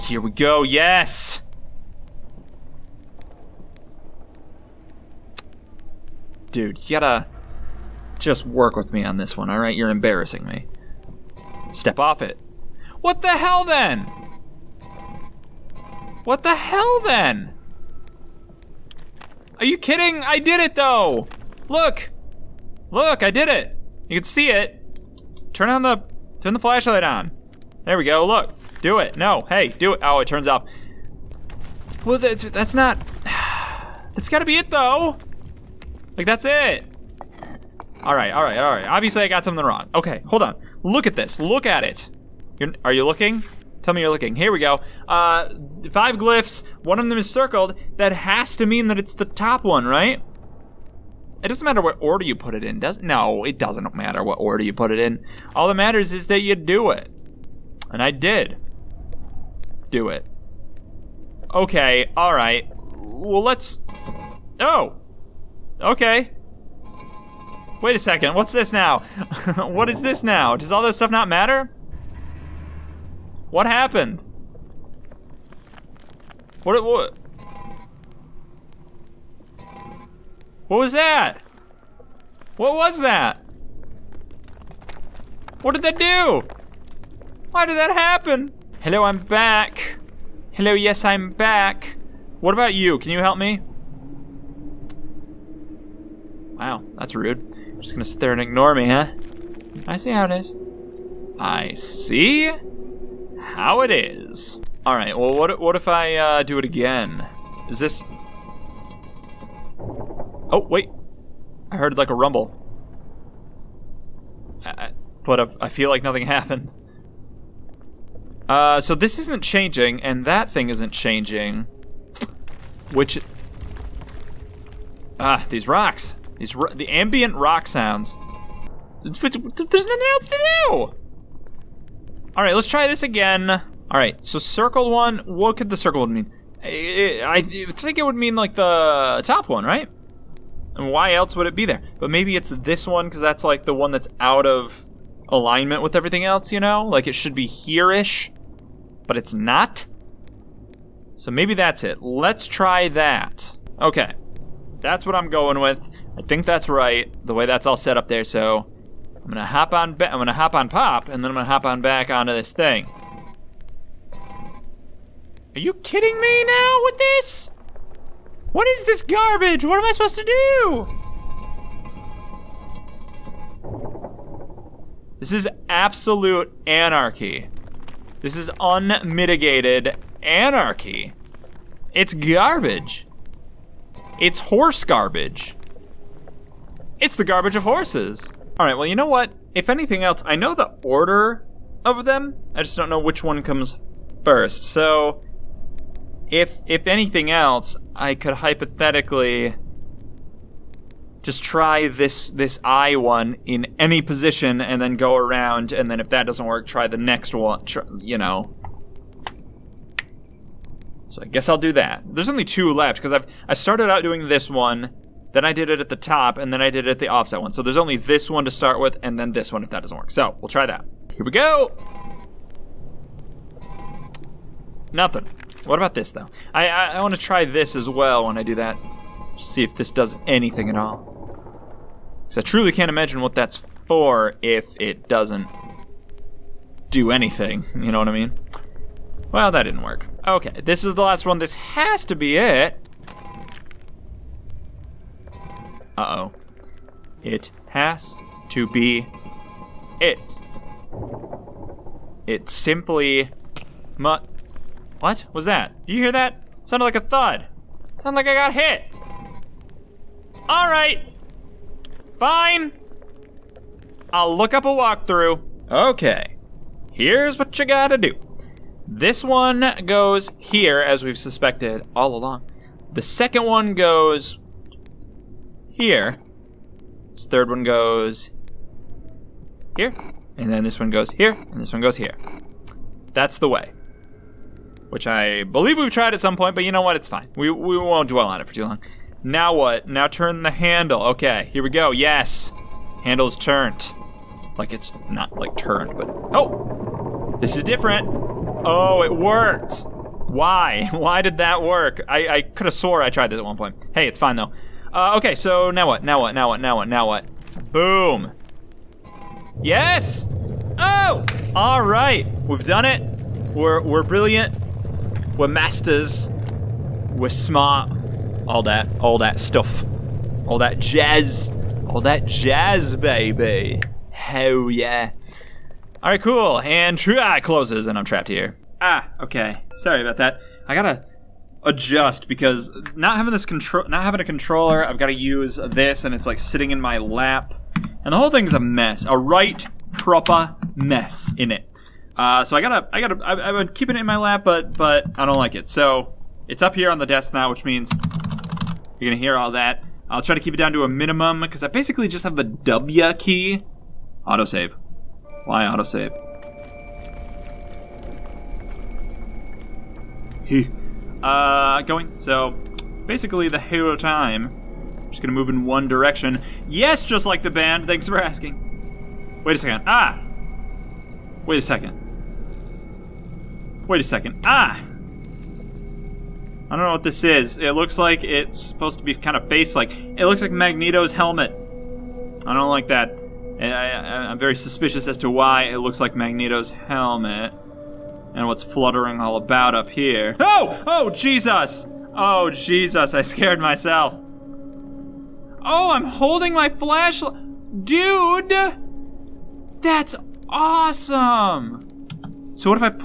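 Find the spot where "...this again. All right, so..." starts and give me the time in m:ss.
2:12.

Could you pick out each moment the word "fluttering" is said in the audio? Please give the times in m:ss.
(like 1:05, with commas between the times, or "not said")
6:28.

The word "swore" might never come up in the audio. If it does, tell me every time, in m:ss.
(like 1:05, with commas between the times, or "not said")
5:02.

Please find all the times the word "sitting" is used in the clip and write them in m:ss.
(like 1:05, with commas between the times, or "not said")
5:36.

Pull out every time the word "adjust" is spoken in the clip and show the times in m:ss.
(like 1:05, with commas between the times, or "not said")
5:31.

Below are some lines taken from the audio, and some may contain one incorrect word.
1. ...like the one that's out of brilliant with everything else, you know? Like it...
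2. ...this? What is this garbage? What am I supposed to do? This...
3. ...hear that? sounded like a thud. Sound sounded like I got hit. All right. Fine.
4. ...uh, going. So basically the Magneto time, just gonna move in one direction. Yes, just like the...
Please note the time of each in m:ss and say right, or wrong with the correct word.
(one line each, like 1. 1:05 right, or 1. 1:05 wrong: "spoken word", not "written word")
1. 2:23 wrong: "alignment", not "brilliant"
2. 2:46 right
3. 4:16 right
4. 6:01 wrong: "Halo", not "Magneto".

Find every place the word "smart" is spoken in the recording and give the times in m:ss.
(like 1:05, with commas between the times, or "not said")
5:17.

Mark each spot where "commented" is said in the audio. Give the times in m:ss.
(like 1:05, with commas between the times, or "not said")
not said.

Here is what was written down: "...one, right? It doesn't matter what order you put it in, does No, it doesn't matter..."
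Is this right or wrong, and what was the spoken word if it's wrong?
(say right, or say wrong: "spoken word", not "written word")
right.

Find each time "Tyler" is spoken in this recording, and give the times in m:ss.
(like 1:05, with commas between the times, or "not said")
not said.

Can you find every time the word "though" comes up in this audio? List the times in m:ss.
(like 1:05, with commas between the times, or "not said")
0:20, 0:34, 3:46, 5:04.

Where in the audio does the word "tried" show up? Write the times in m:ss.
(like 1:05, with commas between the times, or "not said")
4:45, 5:03.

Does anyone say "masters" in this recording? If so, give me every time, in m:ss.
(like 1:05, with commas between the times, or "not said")
5:15.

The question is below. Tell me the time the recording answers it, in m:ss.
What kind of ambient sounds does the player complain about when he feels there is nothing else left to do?
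2:06.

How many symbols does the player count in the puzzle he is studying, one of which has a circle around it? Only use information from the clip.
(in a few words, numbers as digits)
5.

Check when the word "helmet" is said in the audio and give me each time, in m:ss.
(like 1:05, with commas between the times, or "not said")
6:21, 6:26.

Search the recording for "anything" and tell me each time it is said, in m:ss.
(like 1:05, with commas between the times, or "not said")
3:09, 3:16, 3:50, 3:57.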